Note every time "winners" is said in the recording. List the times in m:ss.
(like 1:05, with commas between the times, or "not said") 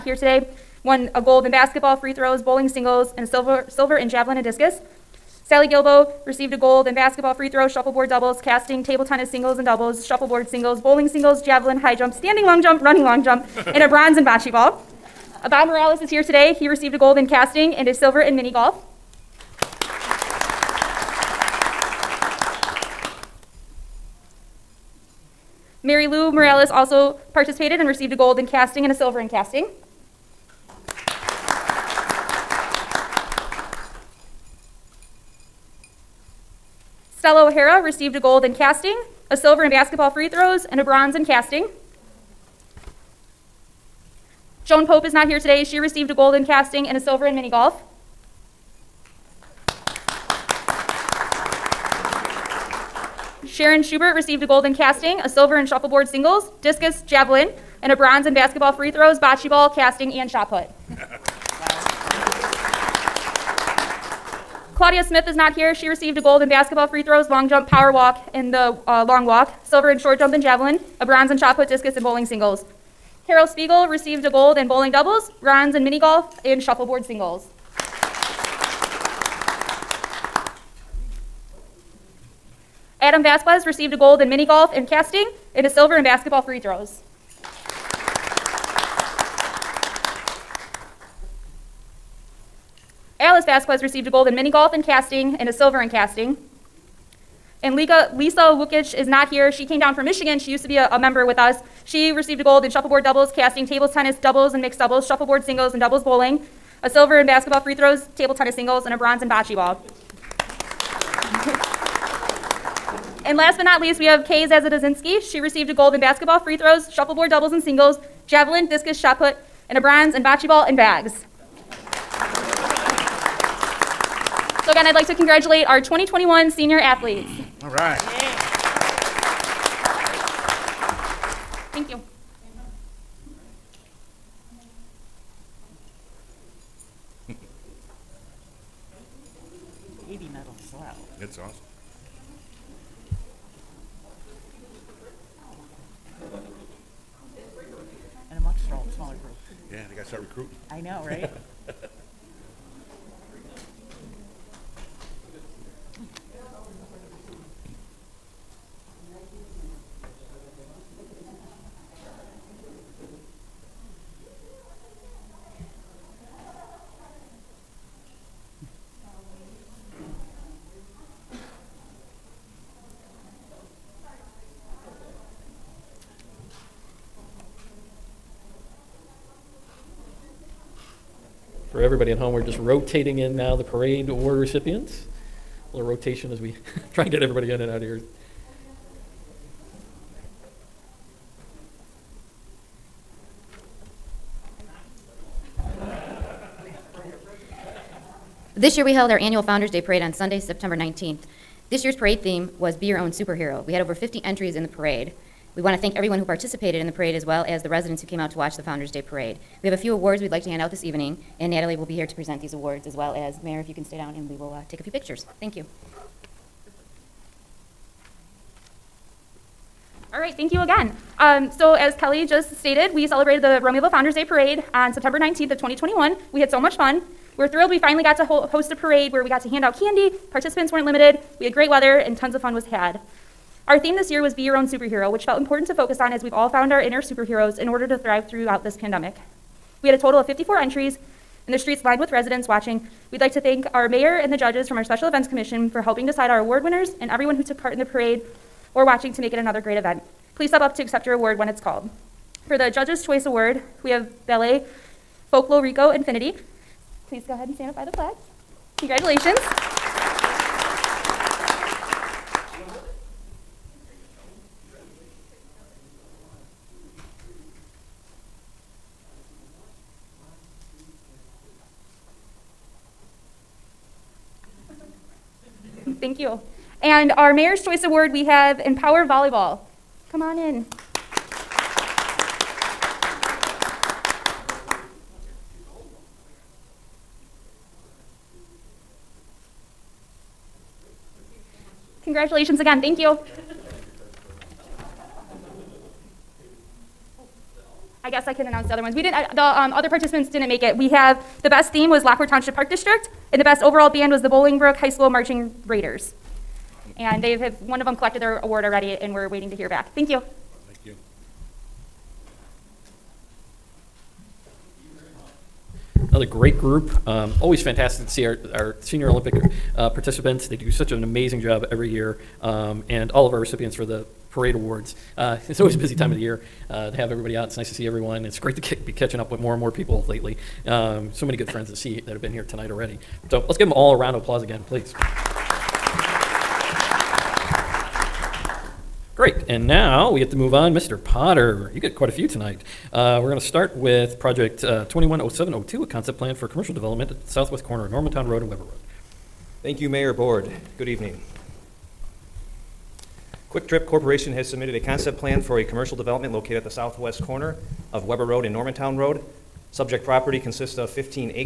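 4:06.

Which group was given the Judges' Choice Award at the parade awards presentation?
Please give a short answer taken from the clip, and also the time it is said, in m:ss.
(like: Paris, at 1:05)
Ballet Folklorico Infinity, at 4:14.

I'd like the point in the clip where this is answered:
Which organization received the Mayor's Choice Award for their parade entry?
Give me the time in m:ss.
4:38.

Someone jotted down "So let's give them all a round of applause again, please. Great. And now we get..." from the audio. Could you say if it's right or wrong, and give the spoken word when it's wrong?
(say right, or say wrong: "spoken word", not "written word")
right.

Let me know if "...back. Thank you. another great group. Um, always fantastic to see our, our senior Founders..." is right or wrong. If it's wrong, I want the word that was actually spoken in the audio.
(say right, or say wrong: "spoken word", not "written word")
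wrong: "Olympic", not "Founders".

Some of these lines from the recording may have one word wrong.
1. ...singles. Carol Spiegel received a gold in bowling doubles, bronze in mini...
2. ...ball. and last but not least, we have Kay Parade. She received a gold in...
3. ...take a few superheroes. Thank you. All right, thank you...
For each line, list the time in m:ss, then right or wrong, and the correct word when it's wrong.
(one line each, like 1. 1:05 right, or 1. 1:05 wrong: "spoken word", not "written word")
1. 1:12 right
2. 1:49 wrong: "Zazadazinski", not "Parade"
3. 3:34 wrong: "pictures", not "superheroes".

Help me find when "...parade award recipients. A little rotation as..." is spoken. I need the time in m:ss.
3:03.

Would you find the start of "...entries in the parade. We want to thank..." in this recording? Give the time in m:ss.
3:24.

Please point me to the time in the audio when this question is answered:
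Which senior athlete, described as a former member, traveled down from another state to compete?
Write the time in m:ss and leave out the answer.
1:38.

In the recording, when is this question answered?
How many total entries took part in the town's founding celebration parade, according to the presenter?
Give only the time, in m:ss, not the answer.
4:00.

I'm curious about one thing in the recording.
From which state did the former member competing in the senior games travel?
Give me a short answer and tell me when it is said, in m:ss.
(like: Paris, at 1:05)
Michigan, at 1:40.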